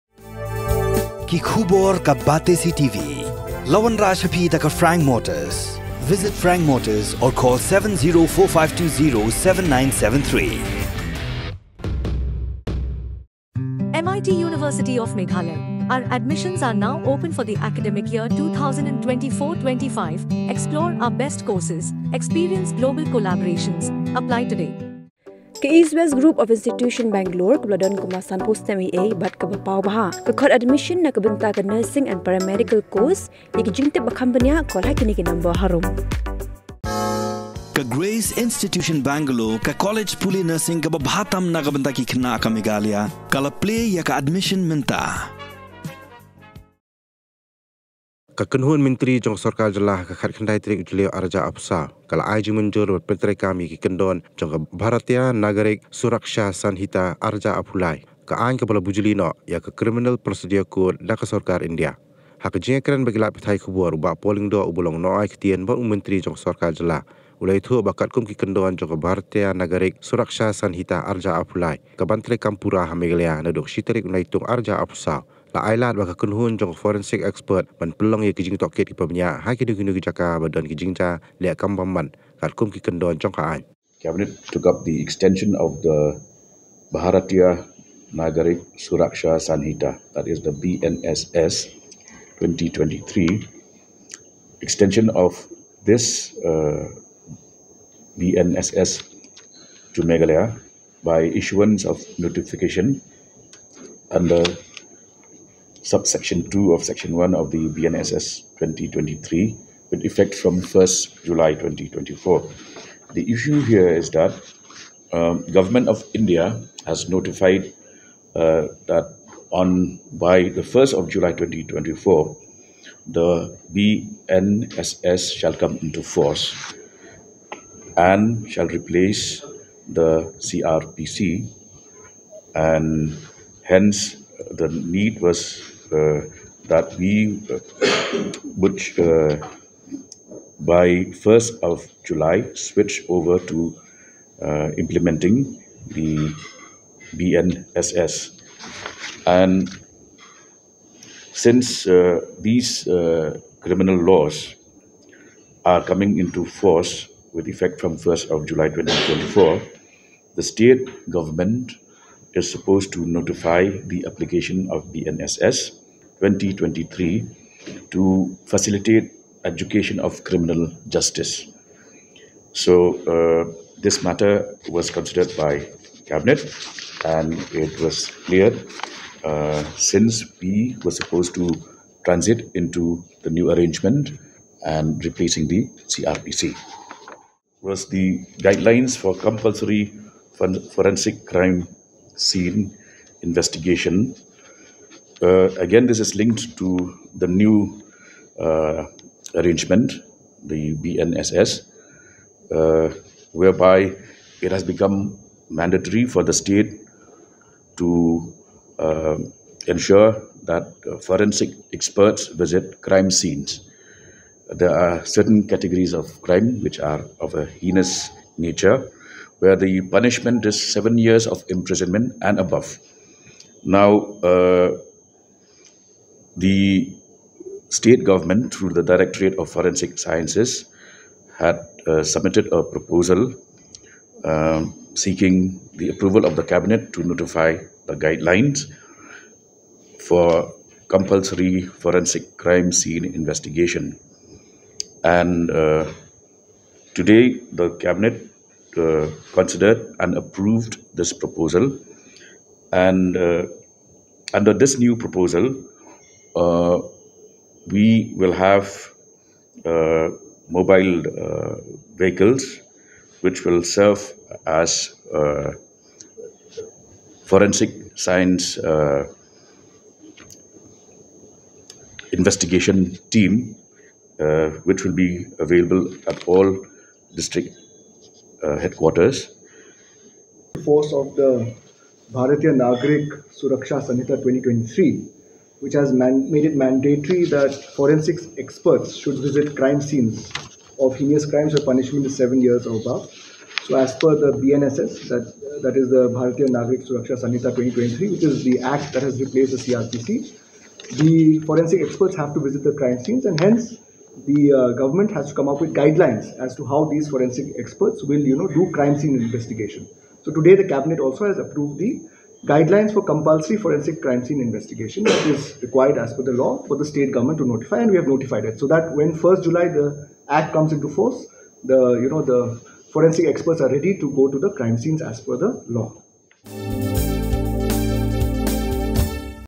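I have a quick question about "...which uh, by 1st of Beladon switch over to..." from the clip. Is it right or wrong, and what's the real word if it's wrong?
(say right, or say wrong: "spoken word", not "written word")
wrong: "July", not "Beladon".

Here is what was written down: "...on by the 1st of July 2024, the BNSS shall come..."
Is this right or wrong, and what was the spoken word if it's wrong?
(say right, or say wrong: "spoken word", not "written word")
right.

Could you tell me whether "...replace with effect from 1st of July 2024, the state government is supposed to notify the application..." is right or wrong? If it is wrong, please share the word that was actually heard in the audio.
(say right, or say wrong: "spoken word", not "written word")
wrong: "force", not "replace".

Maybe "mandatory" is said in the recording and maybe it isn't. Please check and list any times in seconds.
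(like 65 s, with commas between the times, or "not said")
205 s, 286 s.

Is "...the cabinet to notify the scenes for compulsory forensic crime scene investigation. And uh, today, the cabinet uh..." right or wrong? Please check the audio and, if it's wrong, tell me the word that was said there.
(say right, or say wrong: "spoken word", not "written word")
wrong: "guidelines", not "scenes".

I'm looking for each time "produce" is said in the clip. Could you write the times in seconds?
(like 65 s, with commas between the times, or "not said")
not said.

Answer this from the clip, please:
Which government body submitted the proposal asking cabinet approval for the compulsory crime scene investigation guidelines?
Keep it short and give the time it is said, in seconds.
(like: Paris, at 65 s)
Directorate of Forensic Sciences, at 228 s.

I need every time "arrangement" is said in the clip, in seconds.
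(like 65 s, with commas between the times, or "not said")
183 s, 199 s.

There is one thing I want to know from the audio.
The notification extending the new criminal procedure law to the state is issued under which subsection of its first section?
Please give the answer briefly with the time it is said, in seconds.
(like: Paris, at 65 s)
subsection 2, at 105 s.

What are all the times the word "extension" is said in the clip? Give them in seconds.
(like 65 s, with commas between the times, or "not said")
85 s, 94 s.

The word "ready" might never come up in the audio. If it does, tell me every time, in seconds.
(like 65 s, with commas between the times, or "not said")
323 s.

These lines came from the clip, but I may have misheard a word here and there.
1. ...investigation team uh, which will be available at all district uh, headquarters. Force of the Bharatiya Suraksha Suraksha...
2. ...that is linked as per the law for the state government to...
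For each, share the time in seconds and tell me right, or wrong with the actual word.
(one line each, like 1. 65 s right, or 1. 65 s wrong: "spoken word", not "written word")
1. 272 s wrong: "Nagrik", not "Suraksha"
2. 315 s wrong: "required", not "linked".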